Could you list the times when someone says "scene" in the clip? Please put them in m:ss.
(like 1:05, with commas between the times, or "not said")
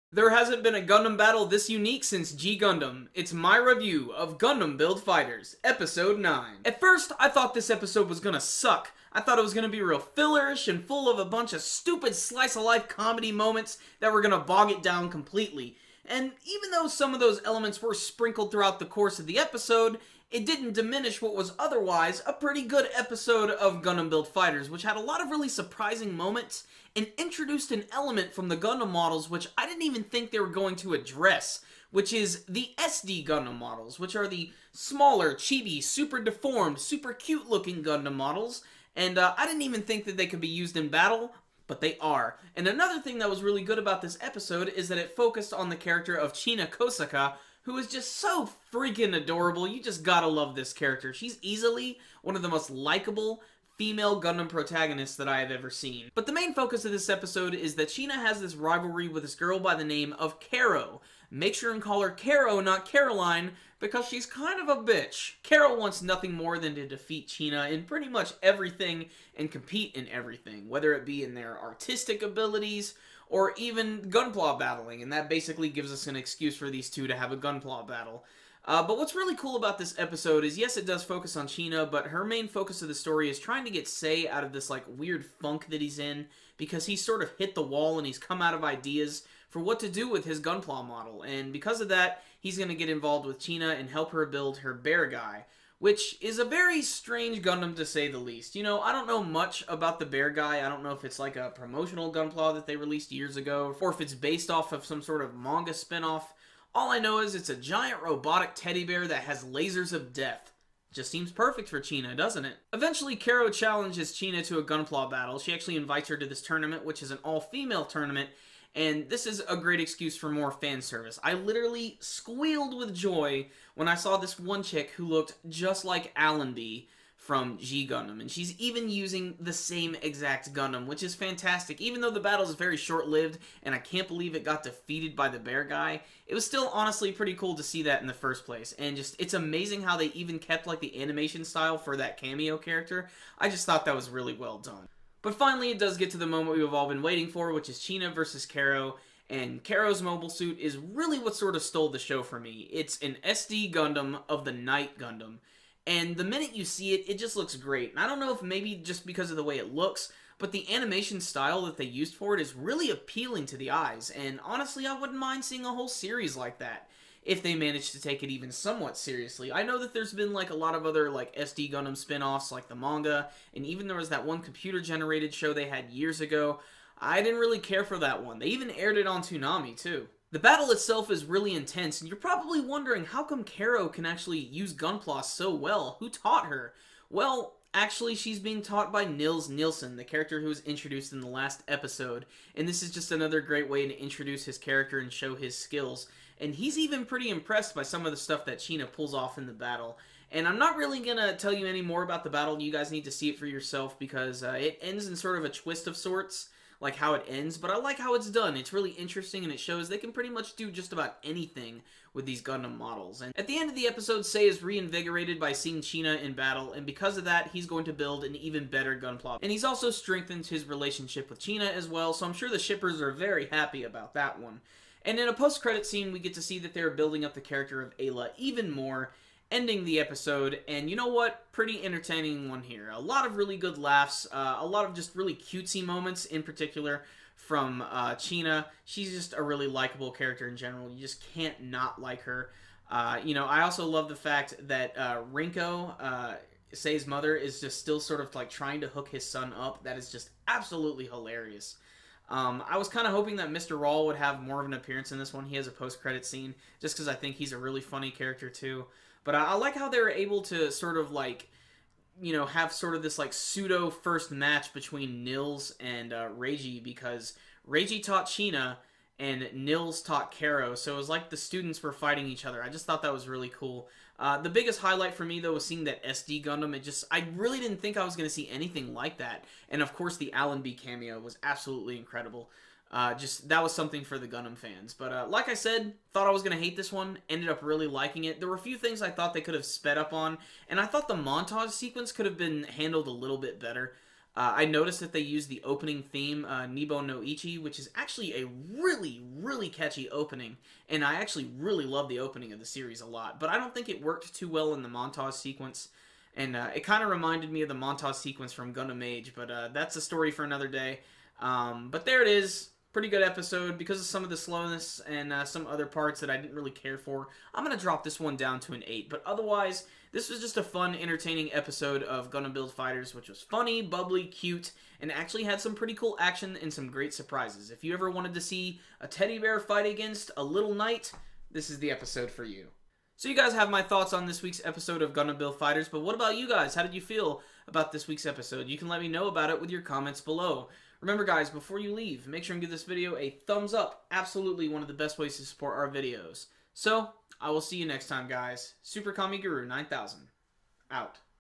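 3:45, 4:16.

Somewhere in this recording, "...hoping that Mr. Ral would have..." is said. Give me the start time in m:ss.
4:13.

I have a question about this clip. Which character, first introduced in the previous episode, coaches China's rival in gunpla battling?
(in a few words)
Nils Nilsson.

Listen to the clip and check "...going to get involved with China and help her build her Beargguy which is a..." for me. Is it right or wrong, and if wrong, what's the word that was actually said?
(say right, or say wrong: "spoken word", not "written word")
right.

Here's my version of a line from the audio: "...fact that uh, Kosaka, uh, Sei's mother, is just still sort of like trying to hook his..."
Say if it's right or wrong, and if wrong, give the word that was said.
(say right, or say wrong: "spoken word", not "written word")
wrong: "Rinko", not "Kosaka".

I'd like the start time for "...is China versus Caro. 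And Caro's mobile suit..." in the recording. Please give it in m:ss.
2:27.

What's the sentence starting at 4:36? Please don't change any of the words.
It just I really didn't think I was going to see anything like that.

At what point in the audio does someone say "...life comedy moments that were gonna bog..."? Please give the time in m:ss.
0:12.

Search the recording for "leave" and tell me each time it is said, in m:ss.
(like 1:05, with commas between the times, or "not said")
5:41.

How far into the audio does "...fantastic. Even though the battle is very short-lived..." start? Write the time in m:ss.
2:11.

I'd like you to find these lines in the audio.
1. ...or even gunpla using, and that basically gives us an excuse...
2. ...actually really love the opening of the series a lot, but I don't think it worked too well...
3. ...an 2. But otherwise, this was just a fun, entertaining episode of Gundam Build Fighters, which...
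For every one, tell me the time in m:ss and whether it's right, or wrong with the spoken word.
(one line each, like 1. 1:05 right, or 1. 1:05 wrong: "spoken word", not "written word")
1. 1:13 wrong: "battling", not "using"
2. 5:01 right
3. 5:18 wrong: "8", not "2".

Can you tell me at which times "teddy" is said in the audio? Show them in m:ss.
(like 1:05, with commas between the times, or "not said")
1:48, 5:29.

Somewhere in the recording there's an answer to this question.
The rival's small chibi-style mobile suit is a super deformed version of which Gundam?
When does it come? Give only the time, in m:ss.
2:34.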